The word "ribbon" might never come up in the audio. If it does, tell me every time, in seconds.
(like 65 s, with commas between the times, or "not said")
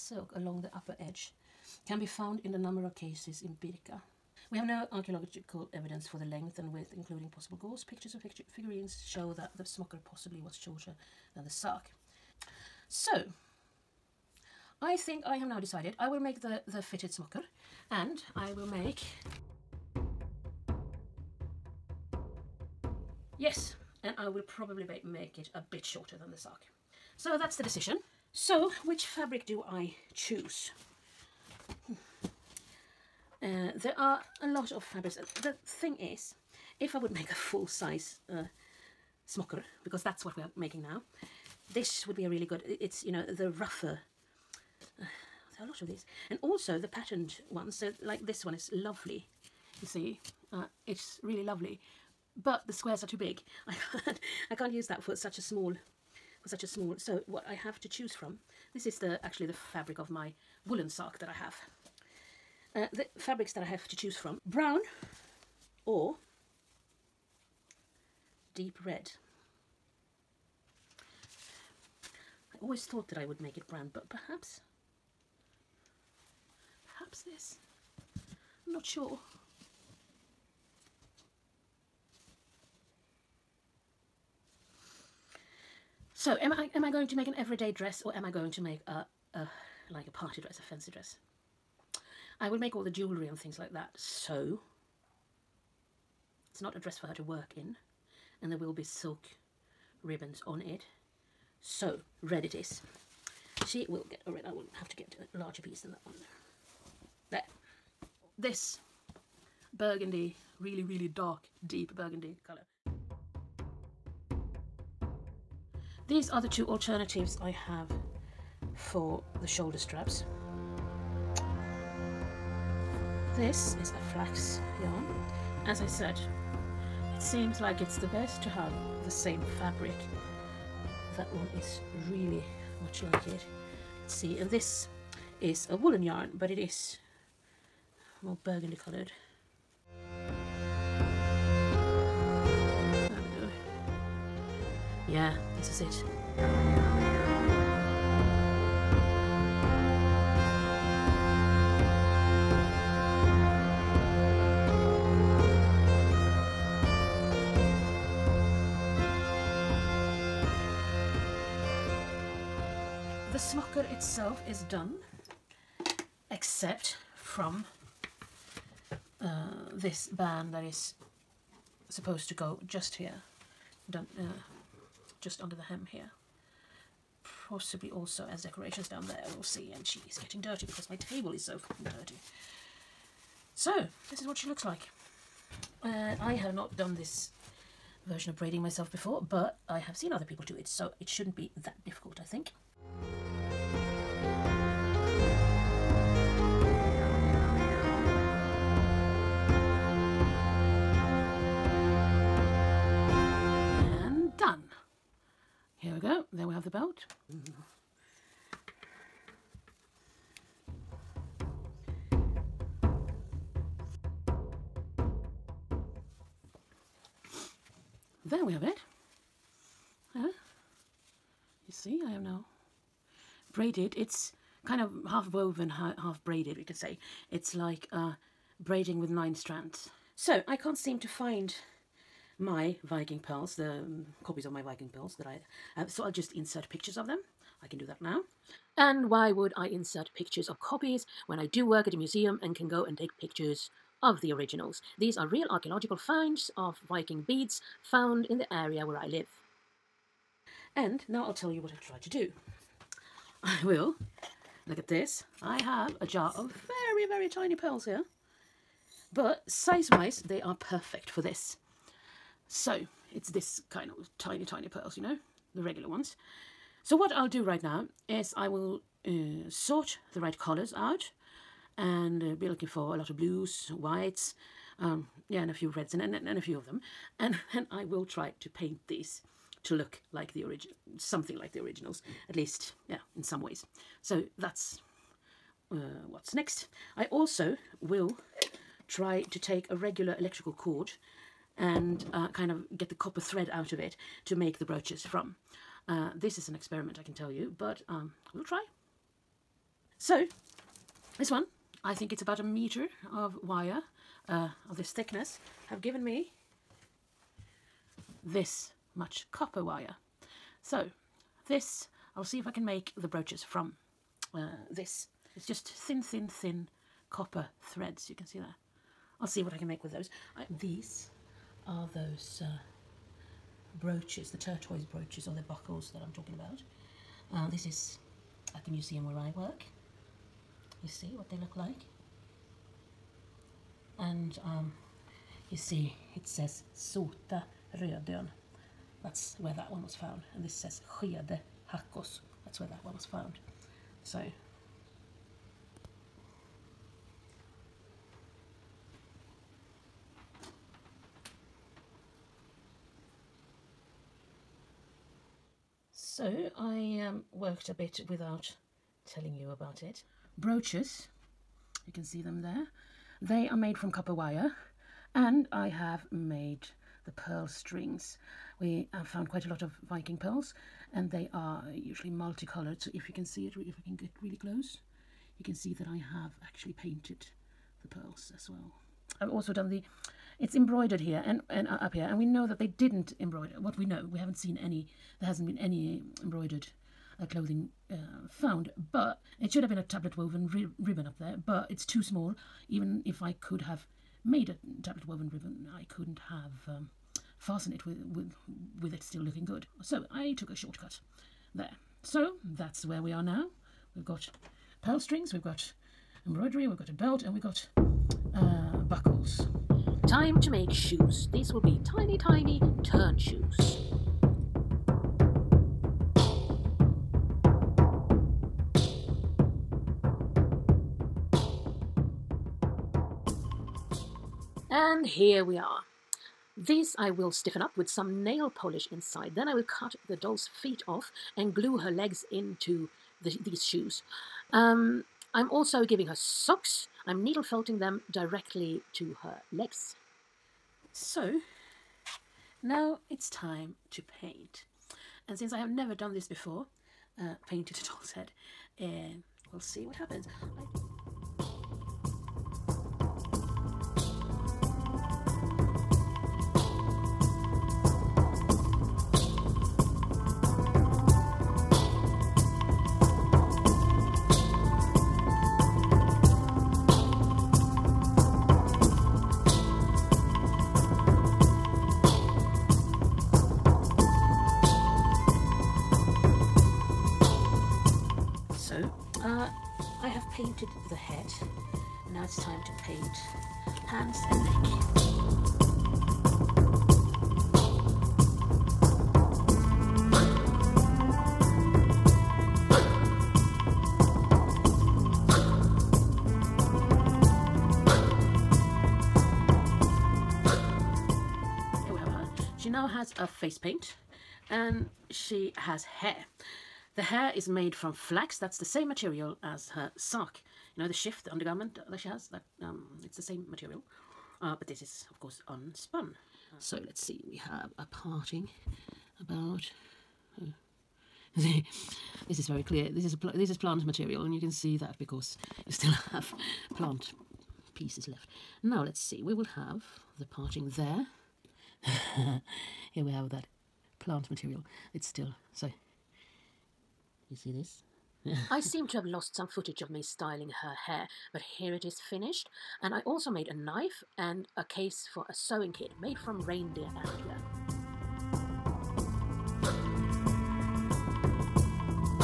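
100 s, 390 s, 395 s.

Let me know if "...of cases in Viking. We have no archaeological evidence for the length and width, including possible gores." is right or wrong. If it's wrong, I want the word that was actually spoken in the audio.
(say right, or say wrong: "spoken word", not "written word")
wrong: "Birka", not "Viking".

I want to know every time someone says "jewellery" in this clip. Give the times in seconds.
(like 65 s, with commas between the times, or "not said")
92 s.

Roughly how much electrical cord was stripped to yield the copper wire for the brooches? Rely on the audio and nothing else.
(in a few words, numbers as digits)
About a meter.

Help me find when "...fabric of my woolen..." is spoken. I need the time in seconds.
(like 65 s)
59 s.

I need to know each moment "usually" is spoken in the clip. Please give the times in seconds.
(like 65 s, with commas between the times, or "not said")
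371 s.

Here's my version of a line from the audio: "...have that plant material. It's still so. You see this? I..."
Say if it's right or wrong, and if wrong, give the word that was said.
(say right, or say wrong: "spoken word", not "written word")
right.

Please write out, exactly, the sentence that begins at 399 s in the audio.
So I took a shortcut there.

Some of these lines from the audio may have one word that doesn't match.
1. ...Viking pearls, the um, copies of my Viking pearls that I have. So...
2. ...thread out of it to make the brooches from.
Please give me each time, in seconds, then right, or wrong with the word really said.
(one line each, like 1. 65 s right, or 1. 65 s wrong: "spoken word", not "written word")
1. 232 s right
2. 293 s right.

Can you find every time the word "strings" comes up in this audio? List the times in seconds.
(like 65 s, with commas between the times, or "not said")
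367 s, 404 s.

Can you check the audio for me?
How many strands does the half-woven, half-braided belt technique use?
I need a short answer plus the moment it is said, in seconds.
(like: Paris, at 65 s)
9, at 229 s.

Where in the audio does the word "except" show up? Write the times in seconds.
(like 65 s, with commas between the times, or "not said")
166 s.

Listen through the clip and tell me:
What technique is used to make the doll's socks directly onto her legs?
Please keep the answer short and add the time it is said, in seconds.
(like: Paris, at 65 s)
Needle felting, at 437 s.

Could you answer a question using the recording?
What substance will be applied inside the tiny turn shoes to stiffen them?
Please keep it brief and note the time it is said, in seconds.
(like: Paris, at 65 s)
Nail polish, at 428 s.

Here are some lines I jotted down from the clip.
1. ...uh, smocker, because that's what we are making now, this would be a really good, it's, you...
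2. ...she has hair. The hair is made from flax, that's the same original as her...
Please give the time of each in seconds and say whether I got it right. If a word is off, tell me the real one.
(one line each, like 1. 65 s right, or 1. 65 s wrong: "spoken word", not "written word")
1. 38 s right
2. 505 s wrong: "material", not "original".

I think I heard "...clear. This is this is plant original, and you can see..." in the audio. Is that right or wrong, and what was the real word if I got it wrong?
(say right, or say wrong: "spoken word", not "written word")
wrong: "material", not "original".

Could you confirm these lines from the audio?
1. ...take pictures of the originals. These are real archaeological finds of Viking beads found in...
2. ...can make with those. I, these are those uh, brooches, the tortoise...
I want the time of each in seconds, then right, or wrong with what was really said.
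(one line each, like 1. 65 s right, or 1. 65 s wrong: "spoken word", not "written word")
1. 242 s right
2. 319 s right.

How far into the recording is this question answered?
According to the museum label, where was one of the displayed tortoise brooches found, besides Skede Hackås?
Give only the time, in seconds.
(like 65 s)
336 s.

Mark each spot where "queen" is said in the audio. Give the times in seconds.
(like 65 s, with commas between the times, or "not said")
not said.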